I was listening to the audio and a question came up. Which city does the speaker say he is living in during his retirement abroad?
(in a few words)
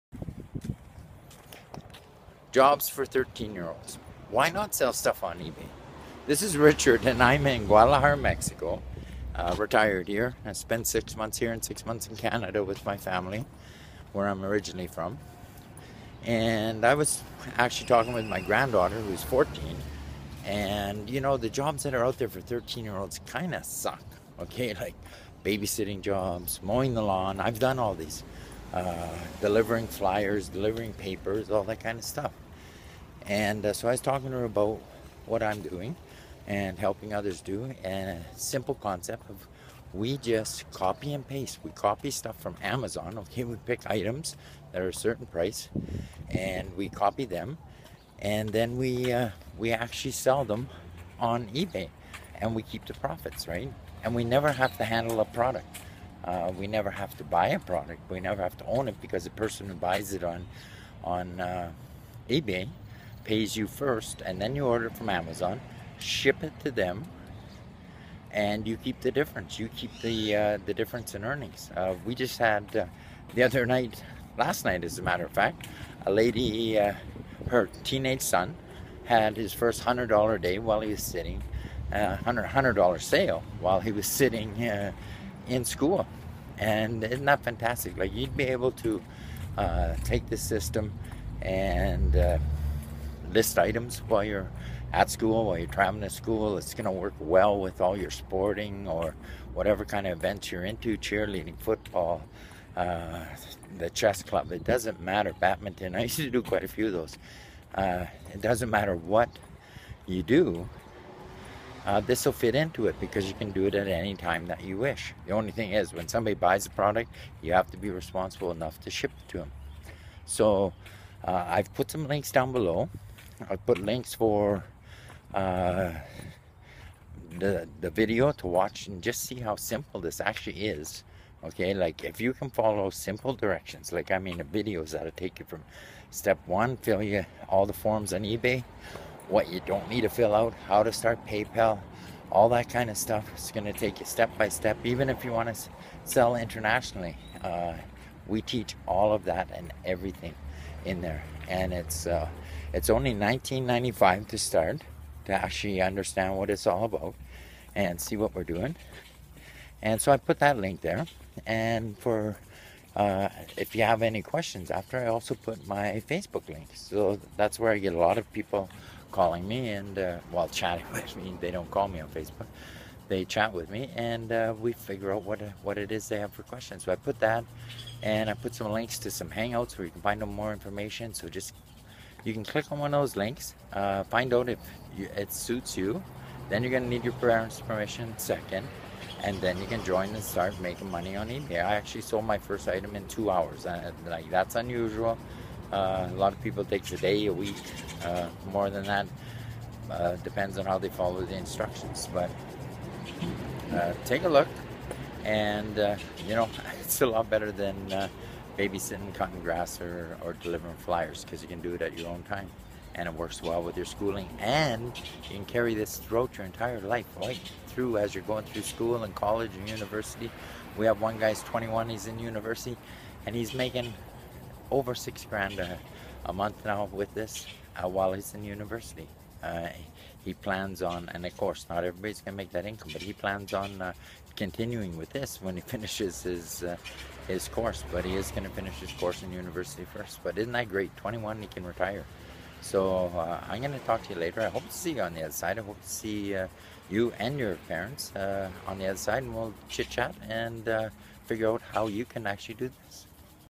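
Guadalajara.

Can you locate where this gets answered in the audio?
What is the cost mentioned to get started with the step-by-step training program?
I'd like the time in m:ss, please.
2:33.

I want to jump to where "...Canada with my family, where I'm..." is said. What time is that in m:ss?
0:12.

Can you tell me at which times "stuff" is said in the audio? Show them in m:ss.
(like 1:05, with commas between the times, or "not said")
0:04, 0:32, 0:42, 2:22.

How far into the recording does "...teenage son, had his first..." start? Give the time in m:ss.
1:17.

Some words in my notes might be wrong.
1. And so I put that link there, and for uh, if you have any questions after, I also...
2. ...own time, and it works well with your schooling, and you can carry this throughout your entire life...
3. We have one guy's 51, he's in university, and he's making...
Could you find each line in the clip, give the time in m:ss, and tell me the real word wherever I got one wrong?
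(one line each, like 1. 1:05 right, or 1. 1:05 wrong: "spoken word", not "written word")
1. 2:39 right
2. 3:32 right
3. 3:40 wrong: "21", not "51".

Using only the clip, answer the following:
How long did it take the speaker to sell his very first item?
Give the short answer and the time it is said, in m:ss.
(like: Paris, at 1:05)
2 hours, at 3:13.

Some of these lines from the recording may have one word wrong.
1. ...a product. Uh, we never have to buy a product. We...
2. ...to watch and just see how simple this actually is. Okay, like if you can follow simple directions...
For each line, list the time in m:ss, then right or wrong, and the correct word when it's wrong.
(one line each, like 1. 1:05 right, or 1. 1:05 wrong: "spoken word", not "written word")
1. 0:55 right
2. 2:08 right.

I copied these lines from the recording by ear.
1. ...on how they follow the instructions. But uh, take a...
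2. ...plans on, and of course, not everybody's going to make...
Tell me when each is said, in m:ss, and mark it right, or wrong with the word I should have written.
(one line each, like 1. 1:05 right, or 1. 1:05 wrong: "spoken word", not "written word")
1. 3:20 right
2. 3:50 right.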